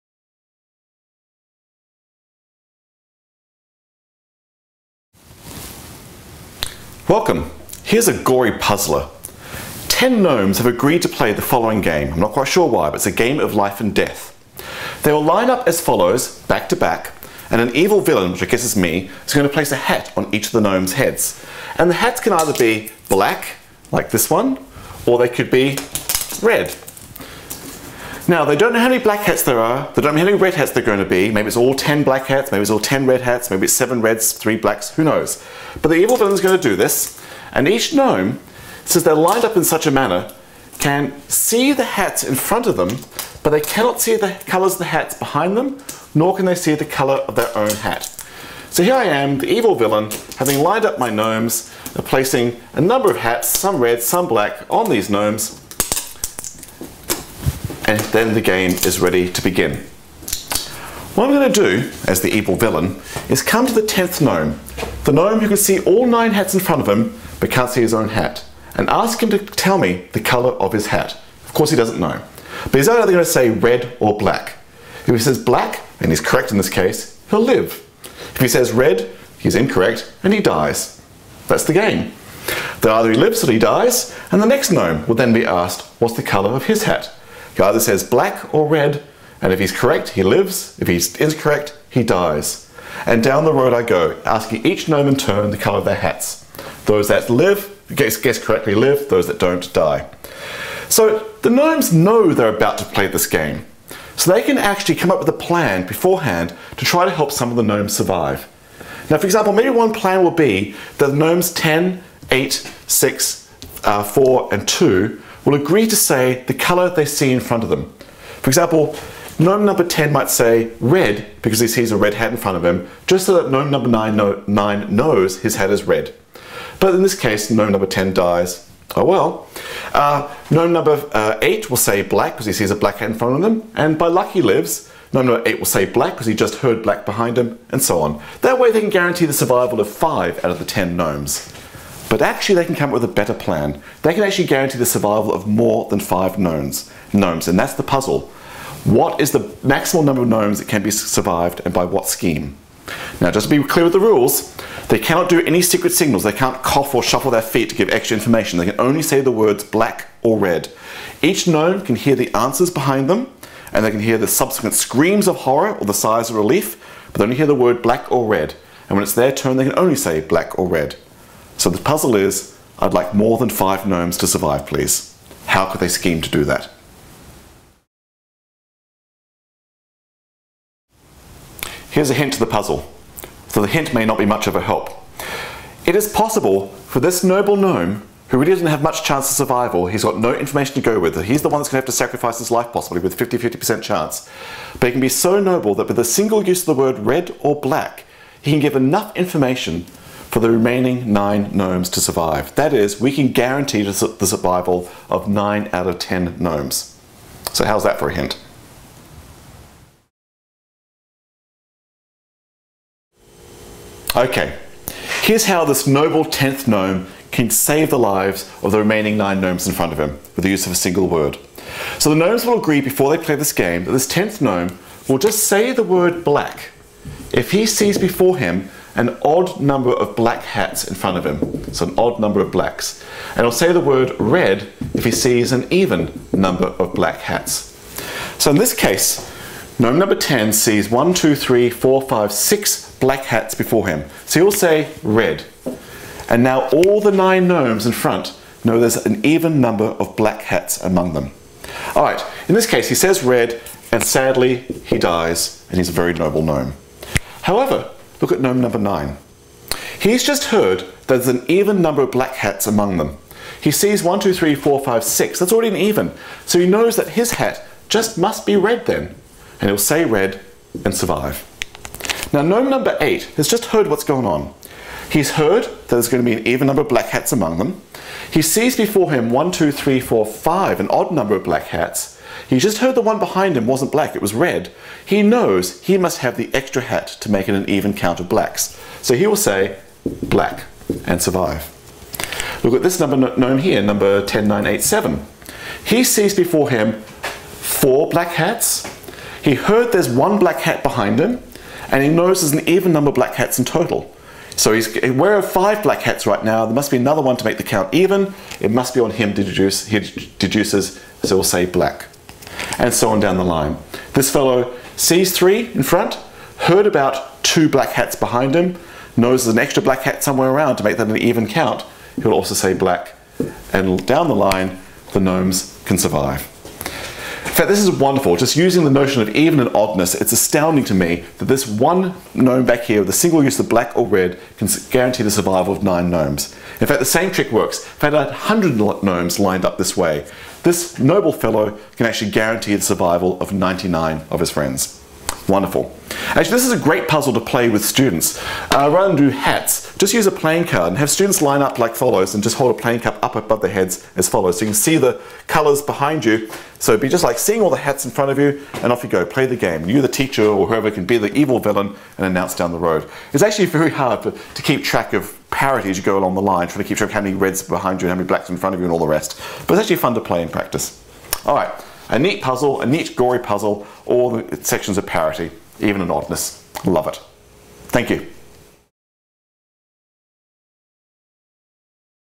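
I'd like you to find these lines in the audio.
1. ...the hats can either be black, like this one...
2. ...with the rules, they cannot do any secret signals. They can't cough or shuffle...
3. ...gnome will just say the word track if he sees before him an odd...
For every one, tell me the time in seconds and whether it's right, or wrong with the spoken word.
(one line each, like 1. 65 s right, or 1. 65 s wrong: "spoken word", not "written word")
1. 21 s right
2. 153 s right
3. 224 s wrong: "black", not "track".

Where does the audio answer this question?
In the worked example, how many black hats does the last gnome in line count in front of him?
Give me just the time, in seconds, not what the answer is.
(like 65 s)
242 s.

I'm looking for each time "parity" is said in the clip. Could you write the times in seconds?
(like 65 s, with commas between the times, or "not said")
365 s, 375 s.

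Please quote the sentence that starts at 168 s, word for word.
And when it's their turn, they can only say black or red.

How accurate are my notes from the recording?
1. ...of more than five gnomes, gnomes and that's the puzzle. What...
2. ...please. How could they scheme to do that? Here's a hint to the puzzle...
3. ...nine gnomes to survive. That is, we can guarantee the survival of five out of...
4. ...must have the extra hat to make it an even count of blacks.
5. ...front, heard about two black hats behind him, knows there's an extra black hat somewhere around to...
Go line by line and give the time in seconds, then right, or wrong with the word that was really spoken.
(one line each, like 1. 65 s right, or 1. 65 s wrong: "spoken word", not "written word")
1. 145 s right
2. 174 s right
3. 201 s wrong: "nine", not "five"
4. 285 s right
5. 315 s right.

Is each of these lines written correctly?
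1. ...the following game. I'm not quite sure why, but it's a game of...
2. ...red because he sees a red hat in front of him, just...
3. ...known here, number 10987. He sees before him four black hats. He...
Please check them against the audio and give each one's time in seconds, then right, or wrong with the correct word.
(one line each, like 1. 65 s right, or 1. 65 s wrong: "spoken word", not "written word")
1. 11 s right
2. 120 s right
3. 293 s right.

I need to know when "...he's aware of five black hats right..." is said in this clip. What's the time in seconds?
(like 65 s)
304 s.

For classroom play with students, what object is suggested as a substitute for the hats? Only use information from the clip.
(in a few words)
playing card.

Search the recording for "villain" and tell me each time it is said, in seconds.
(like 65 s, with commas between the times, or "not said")
18 s, 36 s, 49 s, 62 s, 361 s.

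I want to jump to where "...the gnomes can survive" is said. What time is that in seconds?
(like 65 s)
325 s.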